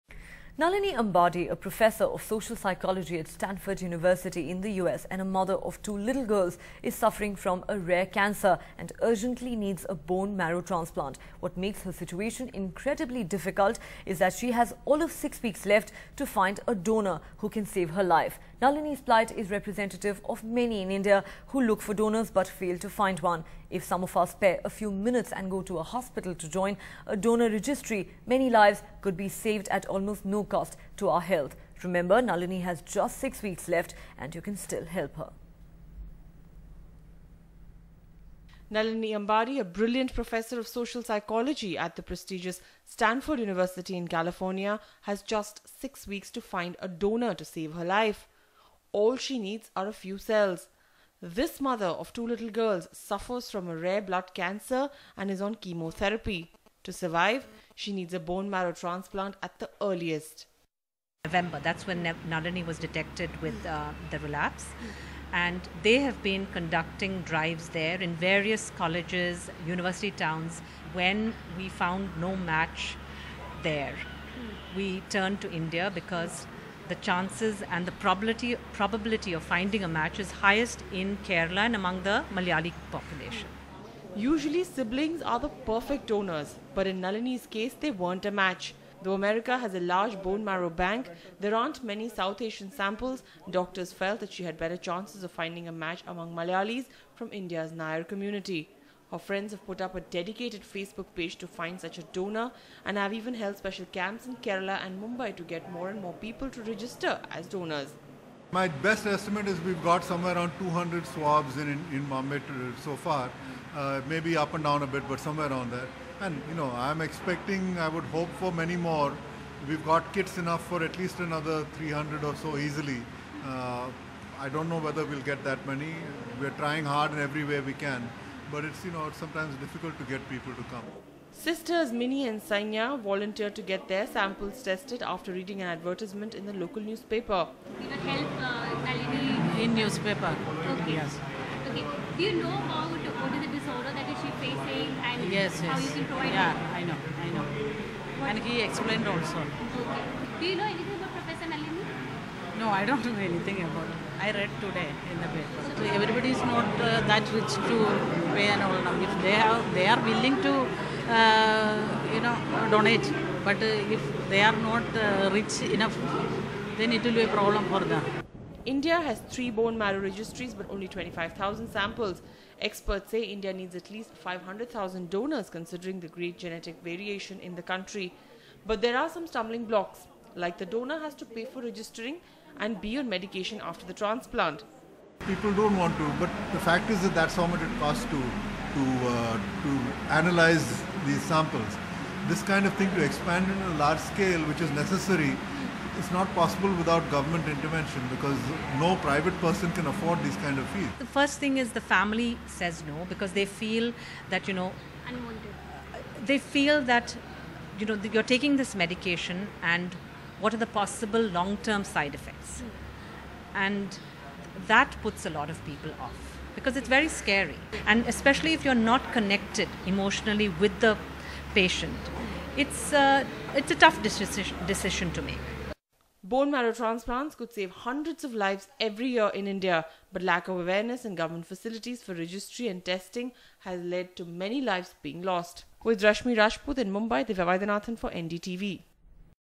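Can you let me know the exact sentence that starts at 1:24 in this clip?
Usually, siblings are the perfect donors, but in Nalini's case, they weren't a match.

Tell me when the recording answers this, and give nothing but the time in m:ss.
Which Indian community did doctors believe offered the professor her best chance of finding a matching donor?
1:37.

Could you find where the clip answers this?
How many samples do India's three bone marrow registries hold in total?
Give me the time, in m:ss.
2:50.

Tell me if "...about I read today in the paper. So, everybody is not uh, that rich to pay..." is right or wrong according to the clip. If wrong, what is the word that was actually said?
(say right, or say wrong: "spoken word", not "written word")
right.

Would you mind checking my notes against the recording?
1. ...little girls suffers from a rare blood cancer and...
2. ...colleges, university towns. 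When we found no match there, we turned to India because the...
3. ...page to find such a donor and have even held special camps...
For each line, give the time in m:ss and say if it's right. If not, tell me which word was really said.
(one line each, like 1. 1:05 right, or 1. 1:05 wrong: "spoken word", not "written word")
1. 0:52 right
2. 1:08 right
3. 1:41 right.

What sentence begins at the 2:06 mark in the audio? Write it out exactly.
We're trying hard in every way we can, but it's you know it's sometimes difficult to get people to come.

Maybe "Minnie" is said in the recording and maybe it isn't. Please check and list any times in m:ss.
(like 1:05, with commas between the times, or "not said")
2:11.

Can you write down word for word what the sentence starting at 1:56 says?
And you know, I'm expecting, I would hope for many more.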